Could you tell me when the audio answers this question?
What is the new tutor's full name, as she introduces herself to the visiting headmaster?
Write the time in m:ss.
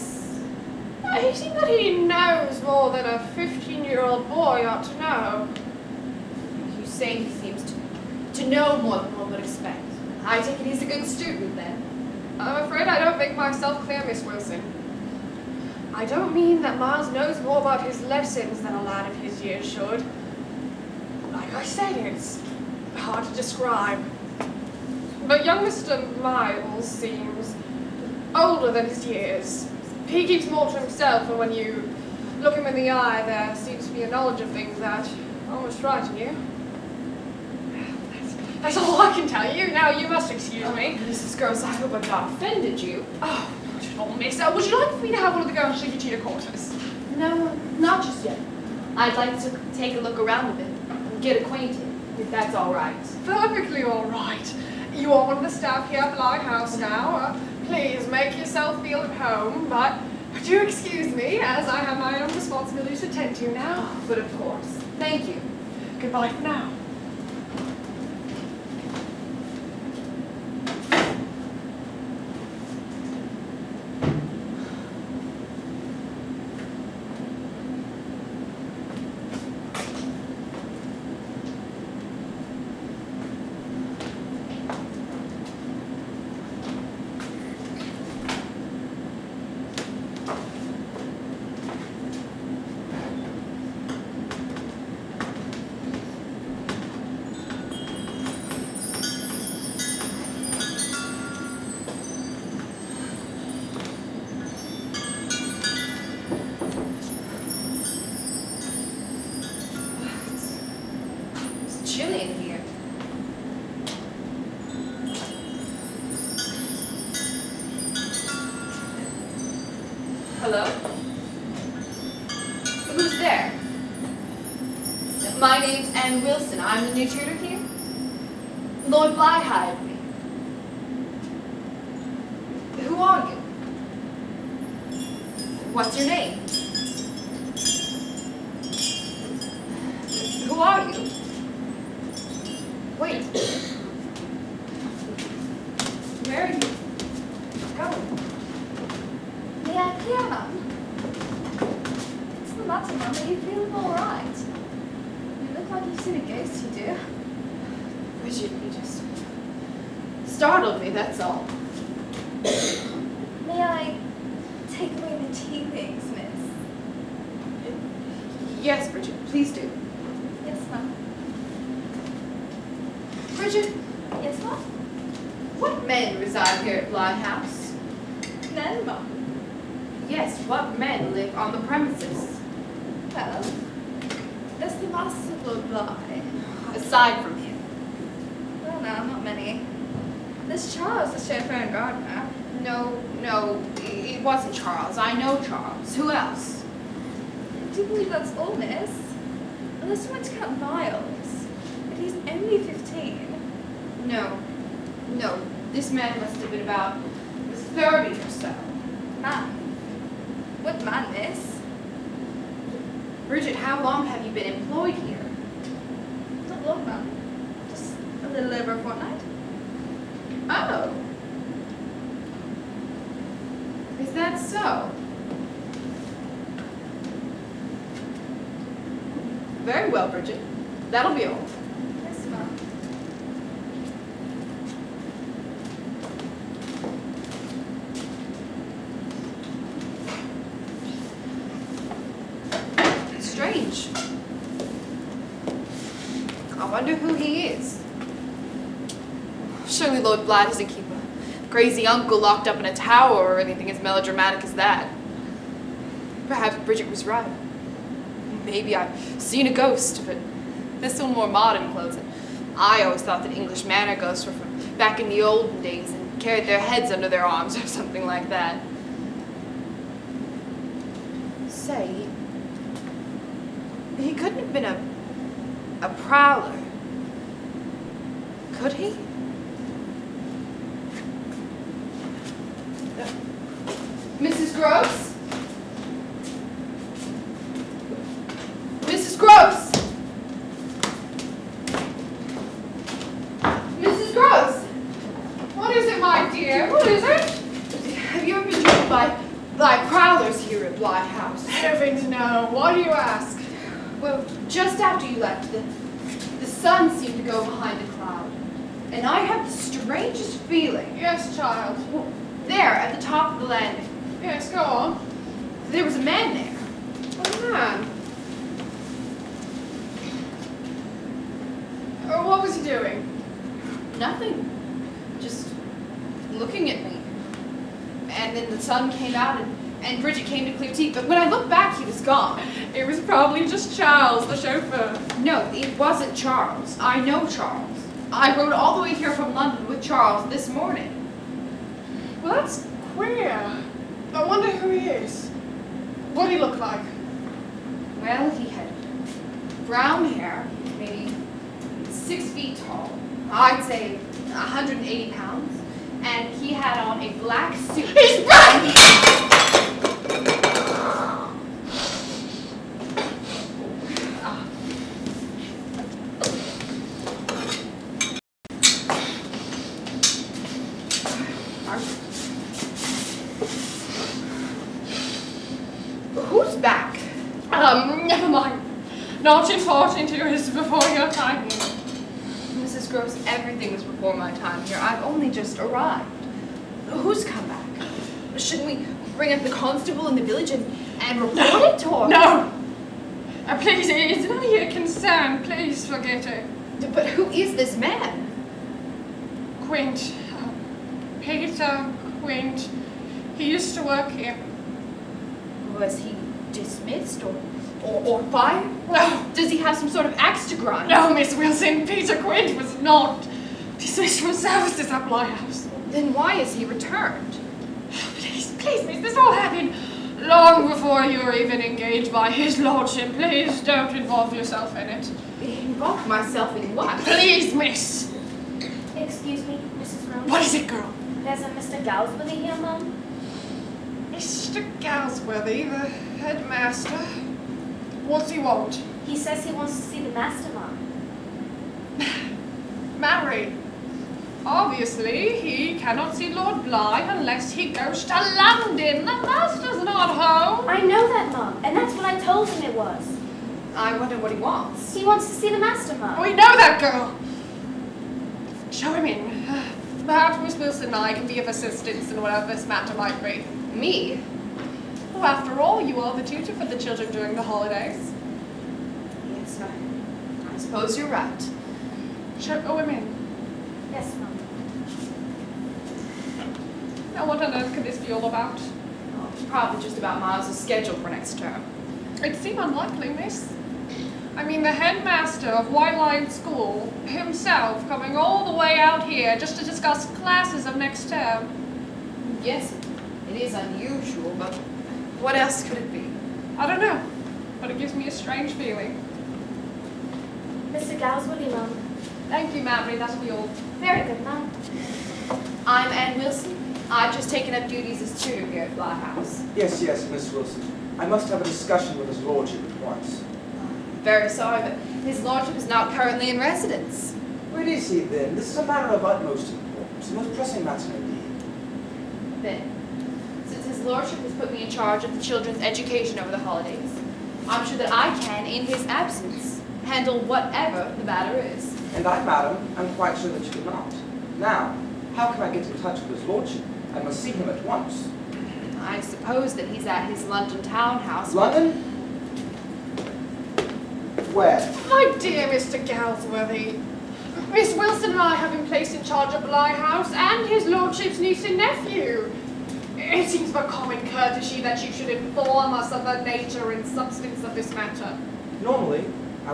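8:25.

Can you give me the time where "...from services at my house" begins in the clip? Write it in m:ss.
6:54.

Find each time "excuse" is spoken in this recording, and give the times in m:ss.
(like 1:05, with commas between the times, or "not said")
0:40, 1:00, 7:08.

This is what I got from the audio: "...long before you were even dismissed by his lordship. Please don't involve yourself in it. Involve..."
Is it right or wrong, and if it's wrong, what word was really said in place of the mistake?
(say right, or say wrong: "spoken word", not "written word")
wrong: "engaged", not "dismissed".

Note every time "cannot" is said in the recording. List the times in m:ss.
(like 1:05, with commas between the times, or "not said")
7:25.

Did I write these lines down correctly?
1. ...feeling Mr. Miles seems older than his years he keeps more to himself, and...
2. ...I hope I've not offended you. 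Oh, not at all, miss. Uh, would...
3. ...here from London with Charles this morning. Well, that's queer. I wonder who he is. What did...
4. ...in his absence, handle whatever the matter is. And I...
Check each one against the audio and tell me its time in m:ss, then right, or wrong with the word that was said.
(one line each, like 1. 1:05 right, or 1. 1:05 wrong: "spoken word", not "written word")
1. 0:25 wrong: "young", not "feeling"
2. 0:41 right
3. 5:38 right
4. 8:48 right.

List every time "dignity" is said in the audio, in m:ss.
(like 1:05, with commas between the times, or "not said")
not said.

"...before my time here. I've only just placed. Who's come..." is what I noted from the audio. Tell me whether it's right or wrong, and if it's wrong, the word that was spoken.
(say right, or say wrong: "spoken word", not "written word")
wrong: "arrived", not "placed".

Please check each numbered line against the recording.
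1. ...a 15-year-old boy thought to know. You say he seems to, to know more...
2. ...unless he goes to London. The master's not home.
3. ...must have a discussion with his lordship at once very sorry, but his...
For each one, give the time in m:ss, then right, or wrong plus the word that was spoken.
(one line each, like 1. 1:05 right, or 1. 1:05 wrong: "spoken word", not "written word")
1. 0:03 wrong: "ought", not "thought"
2. 7:27 right
3. 8:31 right.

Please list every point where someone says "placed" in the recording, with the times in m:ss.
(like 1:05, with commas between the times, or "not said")
9:08.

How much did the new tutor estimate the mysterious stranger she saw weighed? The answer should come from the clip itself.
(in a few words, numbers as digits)
180 pounds.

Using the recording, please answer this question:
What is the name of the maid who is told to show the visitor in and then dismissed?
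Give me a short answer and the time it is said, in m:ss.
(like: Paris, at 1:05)
Mary, at 8:22.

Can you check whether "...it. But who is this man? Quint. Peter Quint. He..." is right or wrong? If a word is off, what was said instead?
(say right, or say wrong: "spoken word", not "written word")
right.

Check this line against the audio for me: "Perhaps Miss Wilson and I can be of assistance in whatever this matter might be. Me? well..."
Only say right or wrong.
right.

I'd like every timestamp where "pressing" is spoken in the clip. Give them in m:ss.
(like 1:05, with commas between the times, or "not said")
8:40.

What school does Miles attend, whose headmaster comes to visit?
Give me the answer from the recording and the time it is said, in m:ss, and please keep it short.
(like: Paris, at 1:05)
White Lion School, at 8:05.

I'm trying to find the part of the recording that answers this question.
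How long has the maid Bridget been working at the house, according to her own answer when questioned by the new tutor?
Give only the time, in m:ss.
3:37.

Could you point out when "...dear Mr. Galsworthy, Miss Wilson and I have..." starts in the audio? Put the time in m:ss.
9:05.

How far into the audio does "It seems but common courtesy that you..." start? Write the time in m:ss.
9:12.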